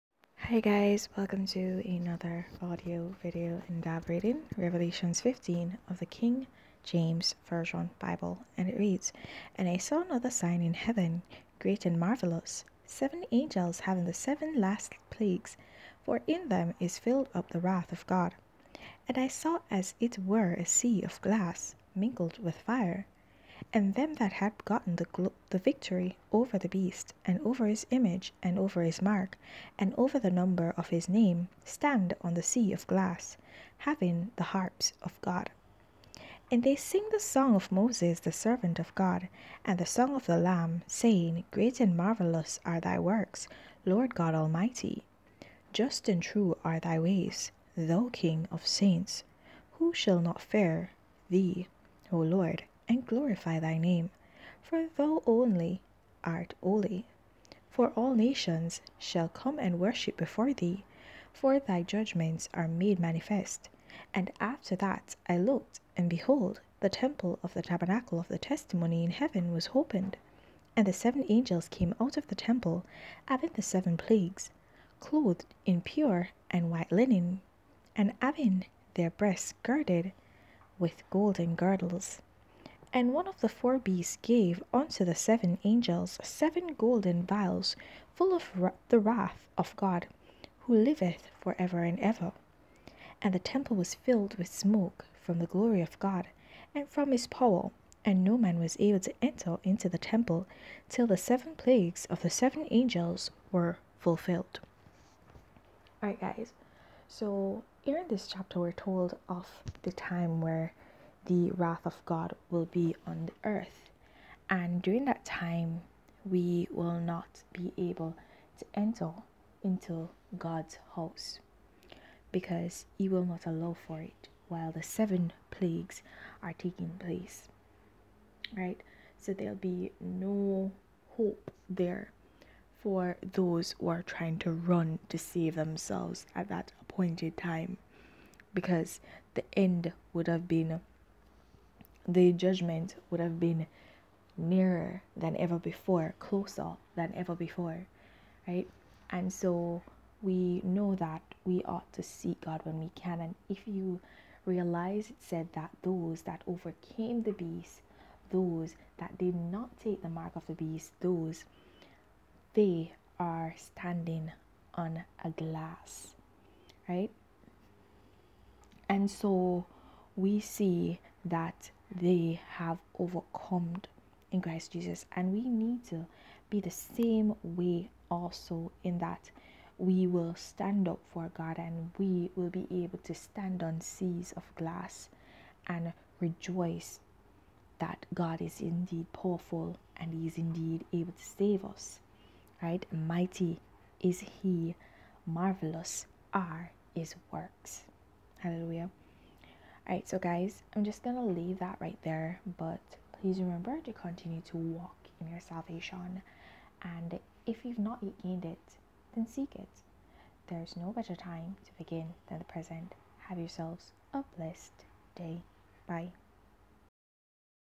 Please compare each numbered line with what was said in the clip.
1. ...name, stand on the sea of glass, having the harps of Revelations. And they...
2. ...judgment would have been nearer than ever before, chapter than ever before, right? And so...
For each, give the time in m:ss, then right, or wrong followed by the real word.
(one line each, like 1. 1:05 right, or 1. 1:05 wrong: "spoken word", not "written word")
1. 0:31 wrong: "God", not "Revelations"
2. 2:22 wrong: "closer", not "chapter".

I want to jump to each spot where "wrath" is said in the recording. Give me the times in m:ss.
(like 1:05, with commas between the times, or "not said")
0:17, 1:28, 1:51.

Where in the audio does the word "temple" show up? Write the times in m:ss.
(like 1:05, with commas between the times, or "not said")
1:06, 1:12, 1:33, 1:39.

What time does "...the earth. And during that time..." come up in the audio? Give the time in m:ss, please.
1:53.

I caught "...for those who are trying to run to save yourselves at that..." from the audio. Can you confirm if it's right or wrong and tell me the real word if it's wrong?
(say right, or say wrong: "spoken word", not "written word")
wrong: "themselves", not "yourselves".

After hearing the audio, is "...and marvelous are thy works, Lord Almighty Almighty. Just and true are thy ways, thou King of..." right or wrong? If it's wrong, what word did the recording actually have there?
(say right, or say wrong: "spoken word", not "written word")
wrong: "God", not "Almighty".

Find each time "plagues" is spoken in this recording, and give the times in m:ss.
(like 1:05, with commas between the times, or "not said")
0:15, 1:13, 1:41, 2:05.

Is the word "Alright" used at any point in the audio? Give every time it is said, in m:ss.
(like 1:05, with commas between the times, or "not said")
1:46, 3:19.